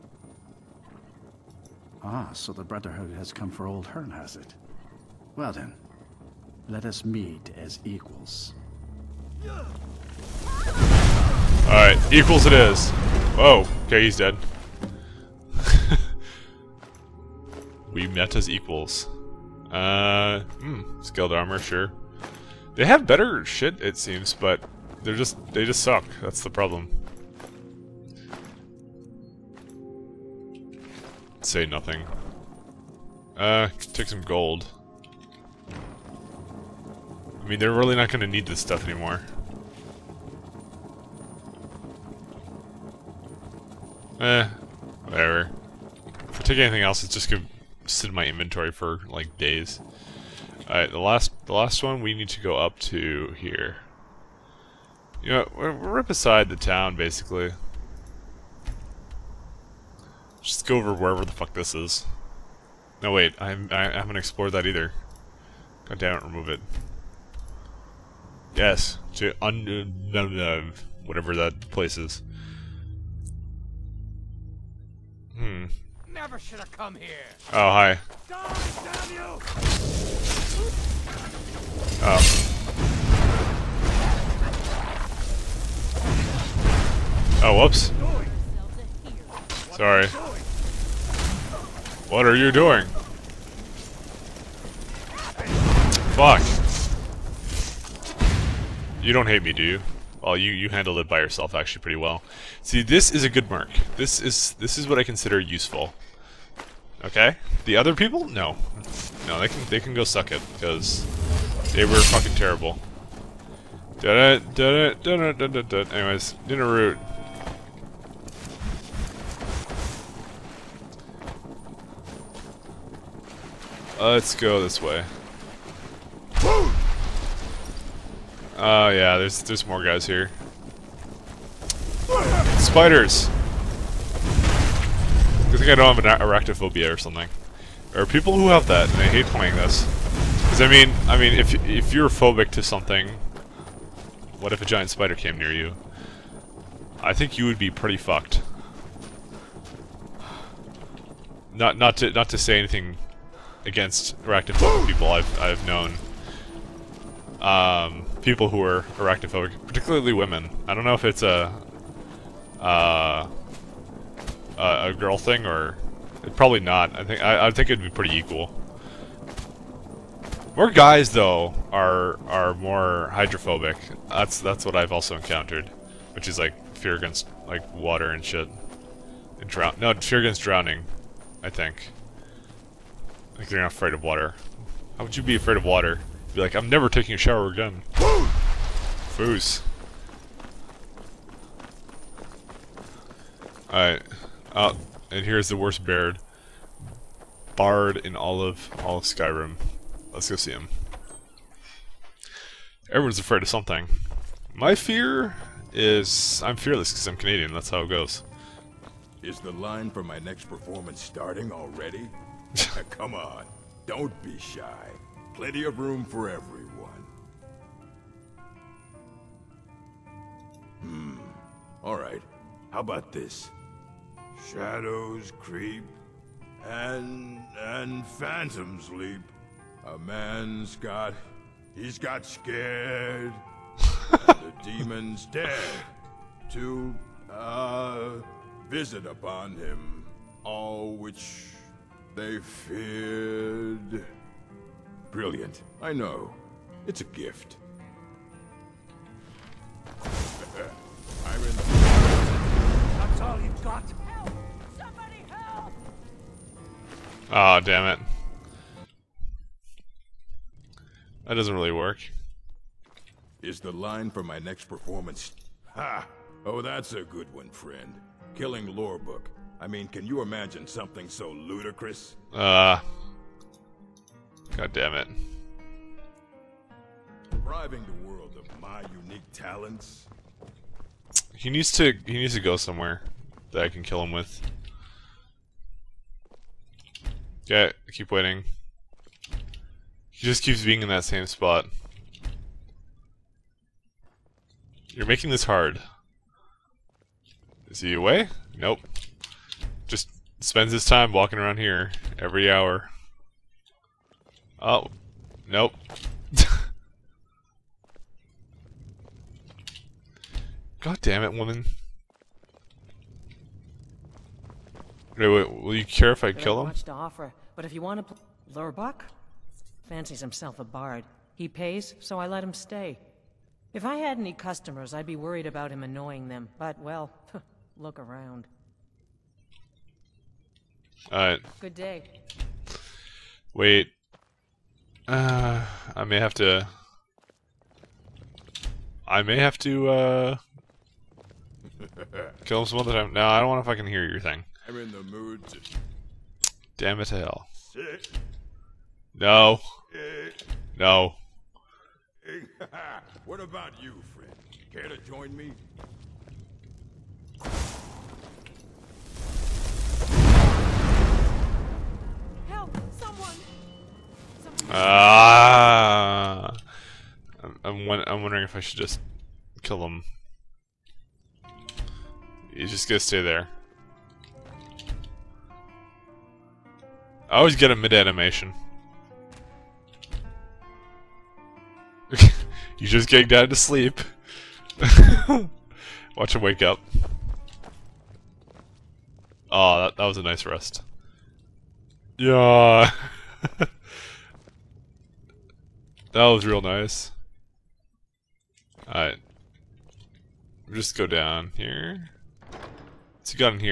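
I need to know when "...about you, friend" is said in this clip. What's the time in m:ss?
5:53.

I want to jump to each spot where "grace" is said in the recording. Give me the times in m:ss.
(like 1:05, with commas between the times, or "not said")
not said.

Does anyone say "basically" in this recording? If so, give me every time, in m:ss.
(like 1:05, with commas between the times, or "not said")
0:56.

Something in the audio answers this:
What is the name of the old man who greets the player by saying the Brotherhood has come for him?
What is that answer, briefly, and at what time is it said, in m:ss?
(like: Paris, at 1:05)
Hern, at 0:03.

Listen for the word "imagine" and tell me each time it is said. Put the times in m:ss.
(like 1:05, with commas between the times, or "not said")
4:30.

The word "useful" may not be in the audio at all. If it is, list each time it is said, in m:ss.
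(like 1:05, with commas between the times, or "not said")
1:45.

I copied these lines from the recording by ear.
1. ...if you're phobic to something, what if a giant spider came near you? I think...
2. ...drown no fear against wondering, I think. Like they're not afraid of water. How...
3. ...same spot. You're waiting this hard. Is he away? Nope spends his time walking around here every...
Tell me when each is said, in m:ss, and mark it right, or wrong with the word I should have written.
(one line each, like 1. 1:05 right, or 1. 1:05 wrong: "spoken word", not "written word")
1. 2:21 right
2. 2:59 wrong: "drowning", not "wondering"
3. 4:51 wrong: "making", not "waiting".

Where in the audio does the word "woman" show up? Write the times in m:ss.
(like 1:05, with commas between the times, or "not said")
5:11.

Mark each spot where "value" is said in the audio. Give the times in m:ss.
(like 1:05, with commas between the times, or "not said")
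not said.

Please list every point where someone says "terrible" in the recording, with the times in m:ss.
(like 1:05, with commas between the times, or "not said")
1:52.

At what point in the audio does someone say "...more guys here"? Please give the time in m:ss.
2:09.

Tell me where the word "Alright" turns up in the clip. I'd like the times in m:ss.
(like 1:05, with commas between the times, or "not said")
0:09, 0:50, 3:13, 5:31, 6:38.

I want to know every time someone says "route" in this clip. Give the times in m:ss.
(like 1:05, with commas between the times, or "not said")
1:56.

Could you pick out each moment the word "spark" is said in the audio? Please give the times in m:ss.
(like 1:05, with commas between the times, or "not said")
not said.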